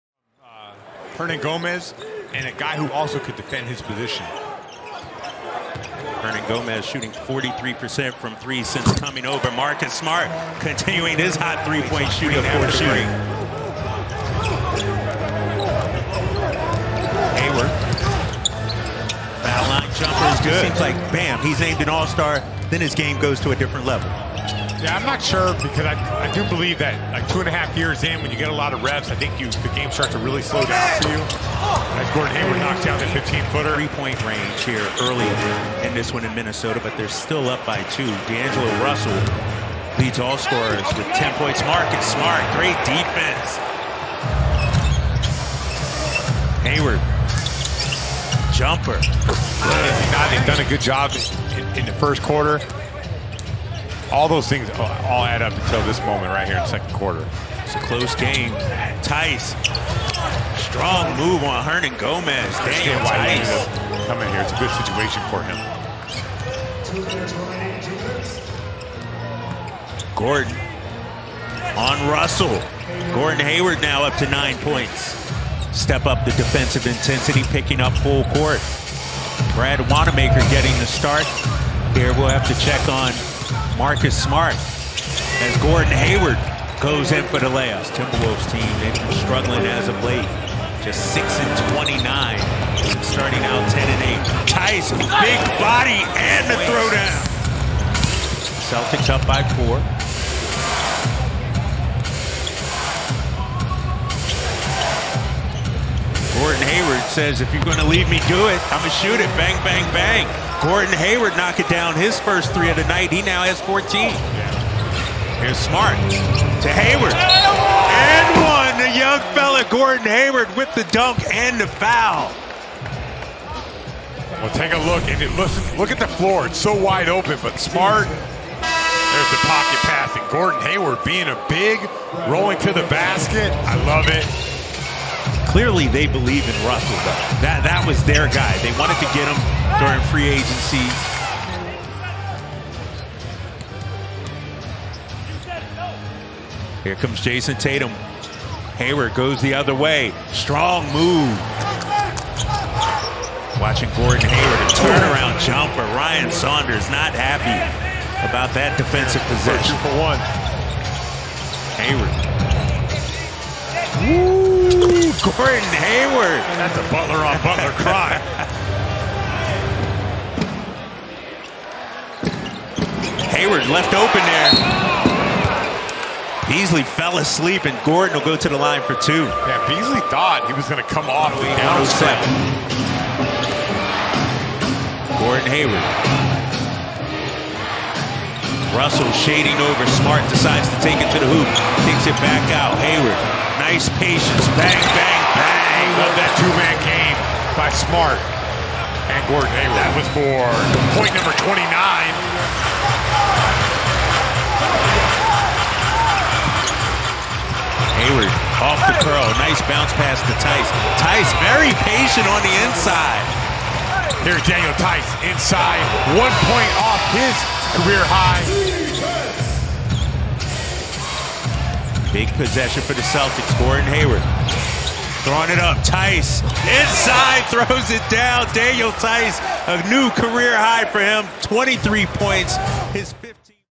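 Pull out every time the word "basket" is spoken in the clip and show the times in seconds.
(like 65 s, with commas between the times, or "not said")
132 s.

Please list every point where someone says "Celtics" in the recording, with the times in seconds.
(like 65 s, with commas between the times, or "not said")
98 s, 223 s.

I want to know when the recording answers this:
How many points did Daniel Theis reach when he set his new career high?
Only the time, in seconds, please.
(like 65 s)
231 s.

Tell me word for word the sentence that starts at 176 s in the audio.
Beasley fell asleep, and Gordon will go to the line for two.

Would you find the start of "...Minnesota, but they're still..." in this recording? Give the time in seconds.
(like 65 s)
36 s.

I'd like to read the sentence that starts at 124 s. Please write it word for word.
Well, take a look, and it, listen, look at the floor.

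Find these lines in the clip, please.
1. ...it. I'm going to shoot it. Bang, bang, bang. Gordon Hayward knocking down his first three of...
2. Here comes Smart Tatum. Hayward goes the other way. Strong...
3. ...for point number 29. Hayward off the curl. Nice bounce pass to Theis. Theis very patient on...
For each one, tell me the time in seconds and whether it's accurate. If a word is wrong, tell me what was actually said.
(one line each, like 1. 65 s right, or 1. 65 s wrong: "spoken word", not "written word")
1. 108 s right
2. 146 s wrong: "Jayson", not "Smart"
3. 200 s right.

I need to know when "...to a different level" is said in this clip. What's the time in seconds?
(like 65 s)
23 s.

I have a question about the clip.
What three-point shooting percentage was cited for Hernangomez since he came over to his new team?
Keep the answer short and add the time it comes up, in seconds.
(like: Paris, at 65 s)
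43%, at 7 s.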